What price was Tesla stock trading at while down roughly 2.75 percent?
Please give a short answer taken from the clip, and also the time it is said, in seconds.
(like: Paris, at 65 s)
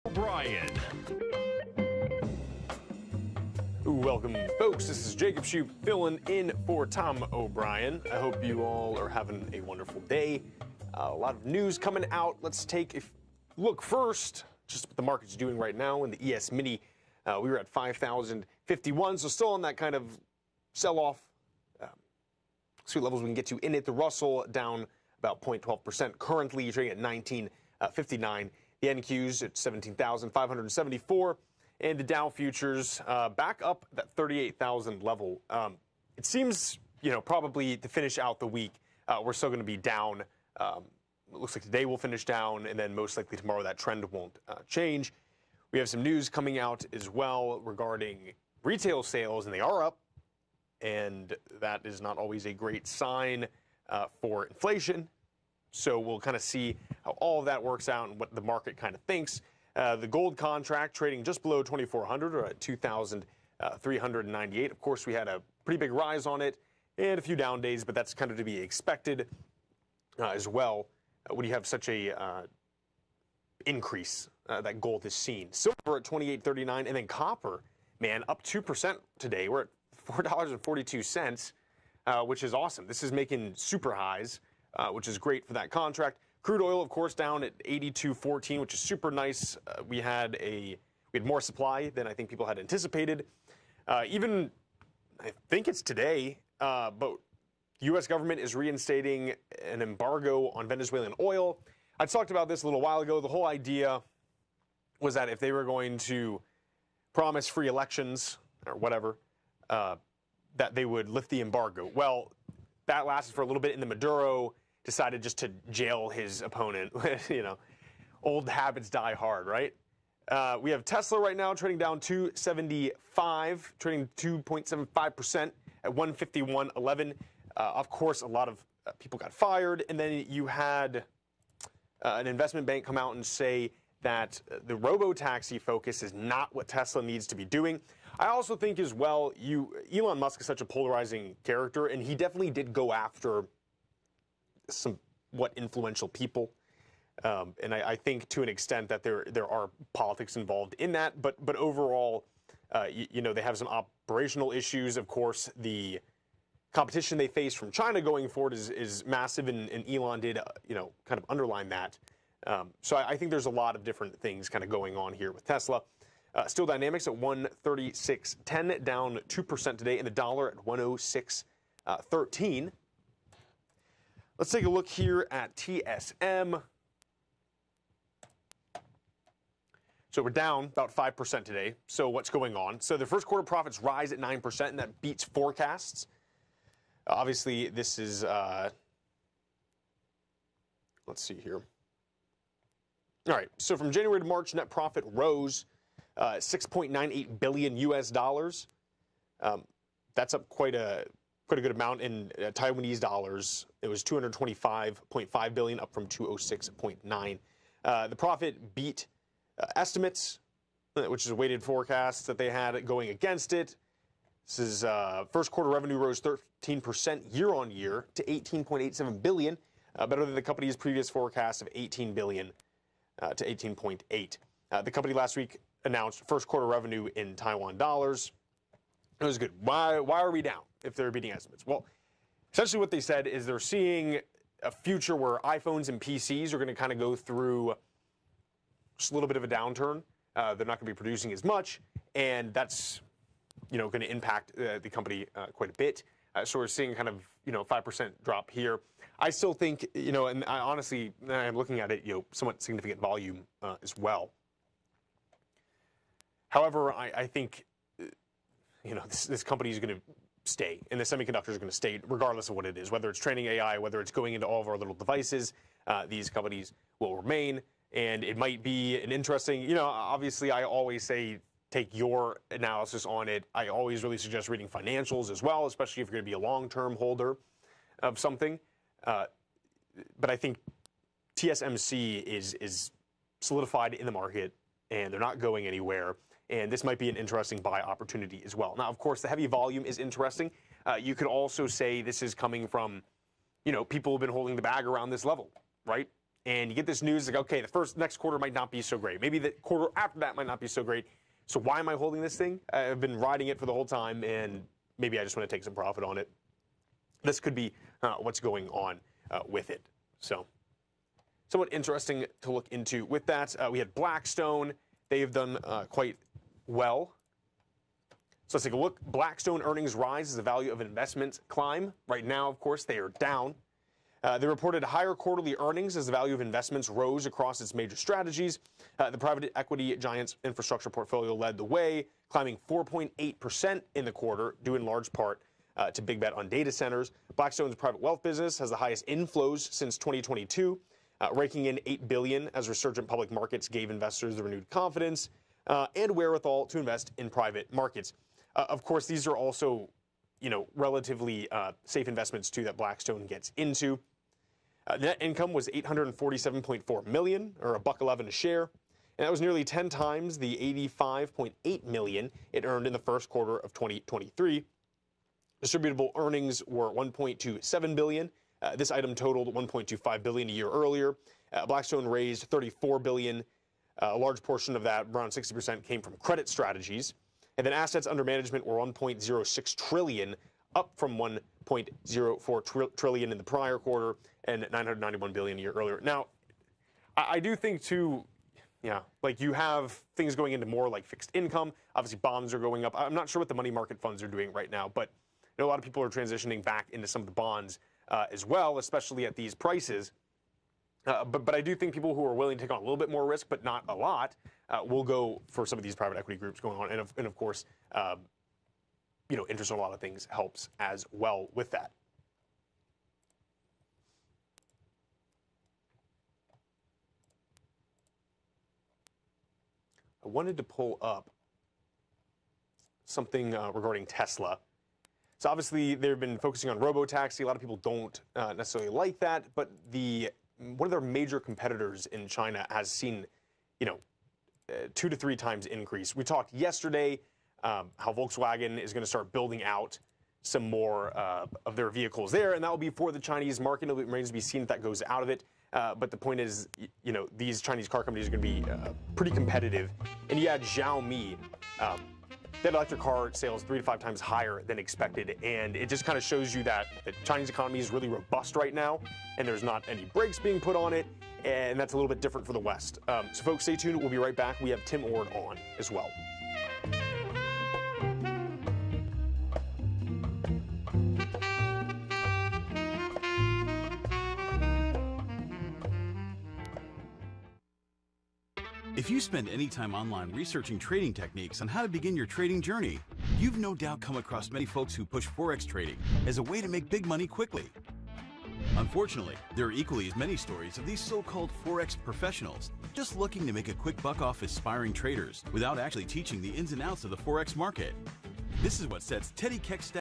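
151.11, at 125 s.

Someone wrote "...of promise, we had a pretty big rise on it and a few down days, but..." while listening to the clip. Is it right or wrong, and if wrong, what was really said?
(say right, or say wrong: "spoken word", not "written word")
wrong: "course", not "promise".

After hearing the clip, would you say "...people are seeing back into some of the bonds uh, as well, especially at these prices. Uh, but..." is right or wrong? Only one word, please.
wrong.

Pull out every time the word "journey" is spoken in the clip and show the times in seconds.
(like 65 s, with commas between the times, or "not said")
482 s.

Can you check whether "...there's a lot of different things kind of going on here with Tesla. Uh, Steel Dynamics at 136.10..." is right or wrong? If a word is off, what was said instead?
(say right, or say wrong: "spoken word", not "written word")
right.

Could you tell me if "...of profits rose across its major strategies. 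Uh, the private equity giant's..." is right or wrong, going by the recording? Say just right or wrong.
wrong.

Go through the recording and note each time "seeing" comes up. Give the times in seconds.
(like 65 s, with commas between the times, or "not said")
233 s, 246 s.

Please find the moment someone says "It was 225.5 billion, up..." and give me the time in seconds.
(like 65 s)
203 s.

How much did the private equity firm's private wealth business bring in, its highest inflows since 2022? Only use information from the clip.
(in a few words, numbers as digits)
$8 billion.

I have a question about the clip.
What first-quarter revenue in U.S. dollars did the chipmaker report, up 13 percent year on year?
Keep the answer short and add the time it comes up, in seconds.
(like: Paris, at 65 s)
18.87 billion, at 218 s.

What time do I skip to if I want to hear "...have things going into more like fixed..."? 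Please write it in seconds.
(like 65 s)
389 s.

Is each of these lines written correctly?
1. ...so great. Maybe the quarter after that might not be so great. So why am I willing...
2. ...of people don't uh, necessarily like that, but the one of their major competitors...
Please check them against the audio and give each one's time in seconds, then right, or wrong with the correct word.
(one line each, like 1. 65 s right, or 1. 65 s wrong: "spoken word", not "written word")
1. 298 s wrong: "holding", not "willing"
2. 427 s right.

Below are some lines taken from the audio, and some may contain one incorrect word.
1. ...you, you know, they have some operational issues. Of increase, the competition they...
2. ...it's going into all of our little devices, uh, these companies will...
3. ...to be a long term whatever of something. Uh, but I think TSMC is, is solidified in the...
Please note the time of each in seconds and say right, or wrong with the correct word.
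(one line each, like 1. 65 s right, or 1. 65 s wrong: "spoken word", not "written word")
1. 152 s wrong: "course", not "increase"
2. 264 s right
3. 276 s wrong: "holder", not "whatever".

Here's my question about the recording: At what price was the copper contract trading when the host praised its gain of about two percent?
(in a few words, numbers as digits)
$4.42.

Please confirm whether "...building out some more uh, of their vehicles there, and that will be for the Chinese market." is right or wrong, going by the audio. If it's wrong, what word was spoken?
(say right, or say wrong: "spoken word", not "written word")
right.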